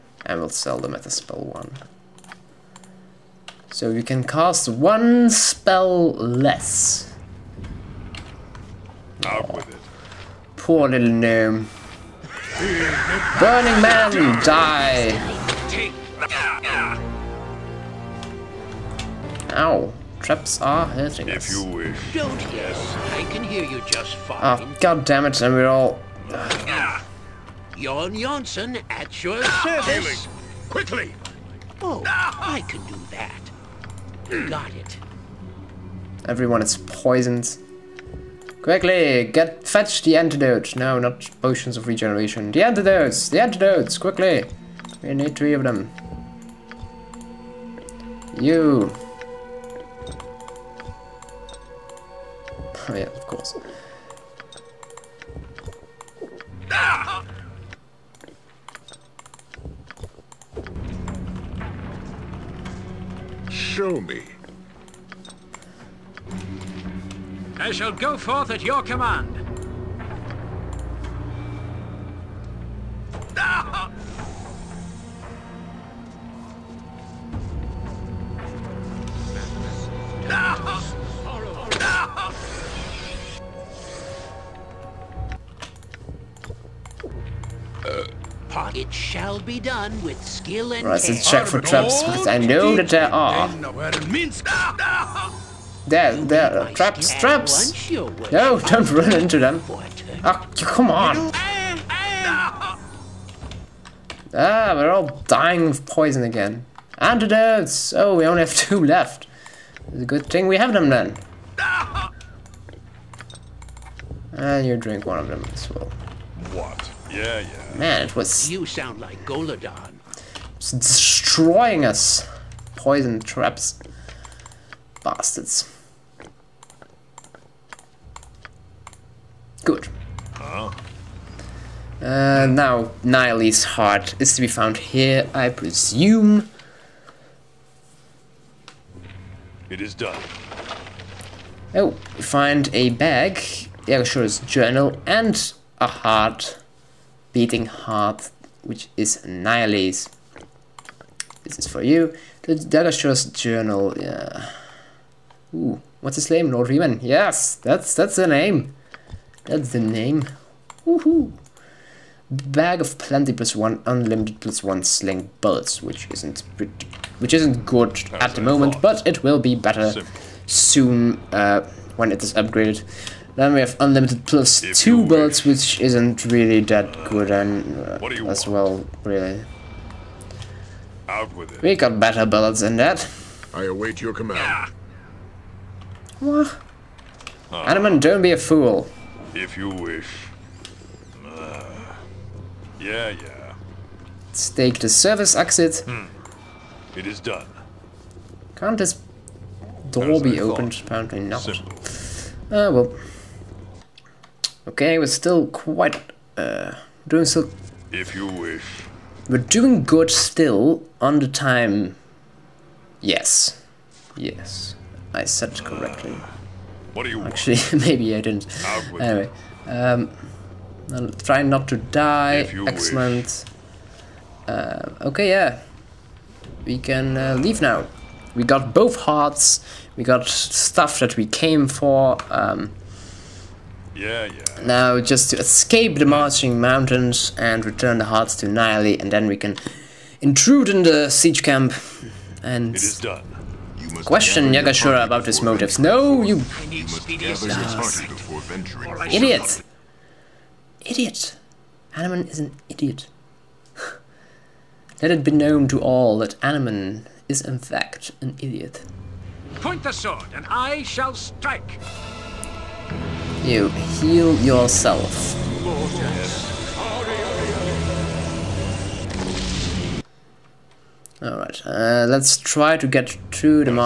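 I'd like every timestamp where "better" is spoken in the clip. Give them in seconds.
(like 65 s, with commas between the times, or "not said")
169 s, 181 s.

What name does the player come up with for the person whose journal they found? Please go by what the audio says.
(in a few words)
Lord Riemann.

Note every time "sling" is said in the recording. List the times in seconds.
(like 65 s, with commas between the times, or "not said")
164 s.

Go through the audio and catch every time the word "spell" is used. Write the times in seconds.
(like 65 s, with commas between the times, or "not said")
1 s, 5 s.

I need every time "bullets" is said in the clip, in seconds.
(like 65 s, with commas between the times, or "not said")
165 s, 175 s, 182 s.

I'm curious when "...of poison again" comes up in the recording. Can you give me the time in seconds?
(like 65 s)
105 s.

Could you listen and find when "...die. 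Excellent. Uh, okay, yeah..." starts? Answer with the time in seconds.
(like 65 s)
221 s.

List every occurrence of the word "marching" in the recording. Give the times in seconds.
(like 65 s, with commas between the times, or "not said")
236 s.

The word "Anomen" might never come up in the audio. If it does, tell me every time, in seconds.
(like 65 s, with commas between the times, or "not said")
251 s, 256 s.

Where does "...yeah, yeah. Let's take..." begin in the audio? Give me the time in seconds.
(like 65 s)
192 s.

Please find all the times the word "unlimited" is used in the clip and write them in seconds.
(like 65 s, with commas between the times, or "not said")
163 s, 173 s.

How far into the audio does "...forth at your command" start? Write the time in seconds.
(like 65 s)
68 s.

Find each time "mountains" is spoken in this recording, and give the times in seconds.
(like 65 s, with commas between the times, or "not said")
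236 s.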